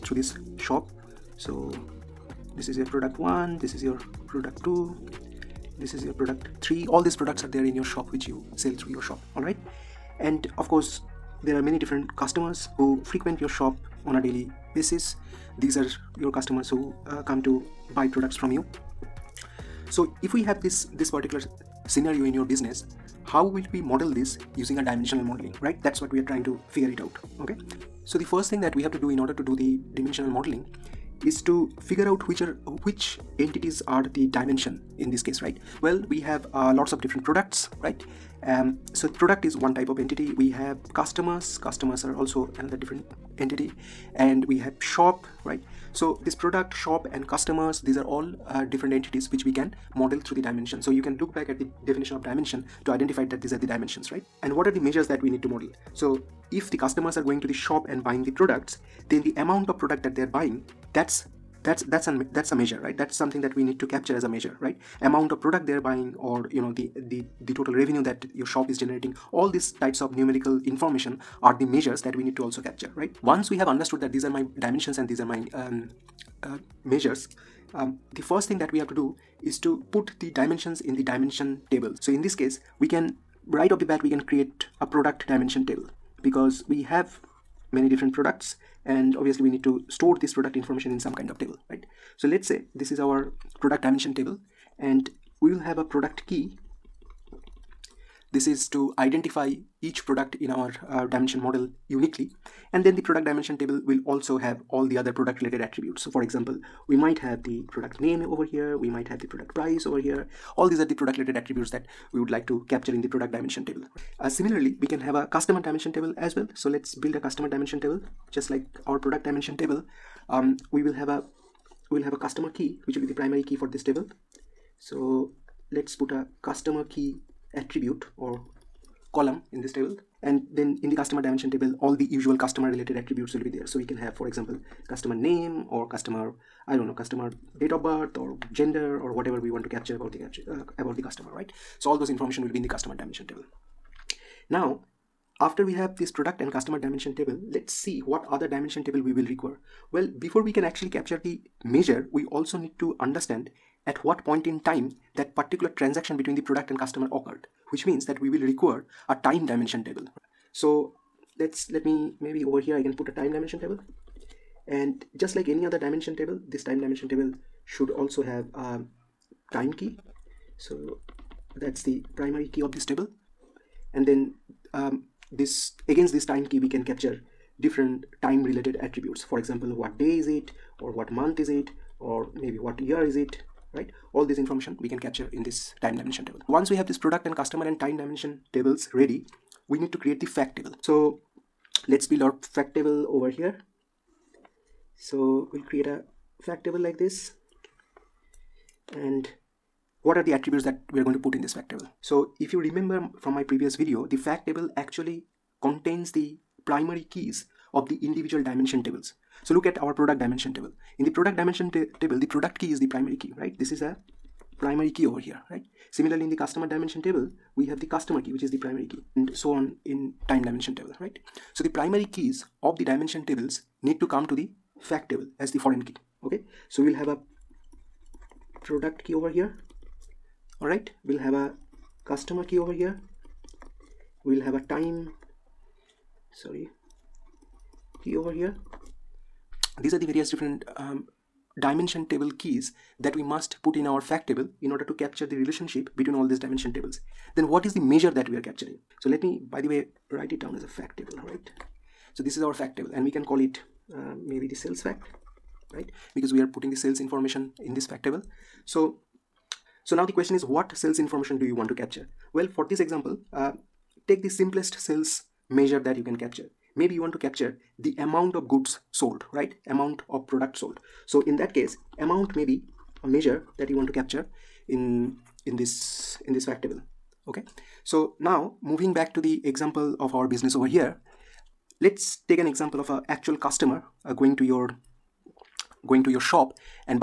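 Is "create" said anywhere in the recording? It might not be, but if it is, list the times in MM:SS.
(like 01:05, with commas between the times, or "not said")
01:24, 03:10, 03:15.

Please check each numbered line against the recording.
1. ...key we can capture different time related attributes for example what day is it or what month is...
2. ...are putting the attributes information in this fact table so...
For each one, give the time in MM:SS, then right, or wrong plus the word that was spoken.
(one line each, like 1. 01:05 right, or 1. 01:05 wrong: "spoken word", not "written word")
1. 02:56 right
2. 04:16 wrong: "sales", not "attributes".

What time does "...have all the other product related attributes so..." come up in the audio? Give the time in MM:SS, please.
01:44.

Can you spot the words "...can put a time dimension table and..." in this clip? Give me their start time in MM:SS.
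02:42.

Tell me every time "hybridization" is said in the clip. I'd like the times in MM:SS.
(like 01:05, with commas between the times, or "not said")
not said.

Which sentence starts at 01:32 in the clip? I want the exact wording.
So let's say this is our product dimension table and we will have a product key.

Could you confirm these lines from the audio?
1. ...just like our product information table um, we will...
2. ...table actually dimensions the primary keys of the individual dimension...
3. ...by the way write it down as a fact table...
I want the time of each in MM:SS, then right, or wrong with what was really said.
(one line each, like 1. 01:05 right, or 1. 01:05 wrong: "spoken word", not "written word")
1. 01:58 wrong: "dimension", not "information"
2. 03:24 wrong: "contains", not "dimensions"
3. 04:09 right.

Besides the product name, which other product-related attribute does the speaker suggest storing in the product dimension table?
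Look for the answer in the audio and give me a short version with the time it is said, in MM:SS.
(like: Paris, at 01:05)
Product price, at 01:49.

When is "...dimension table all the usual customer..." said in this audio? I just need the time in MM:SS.
02:11.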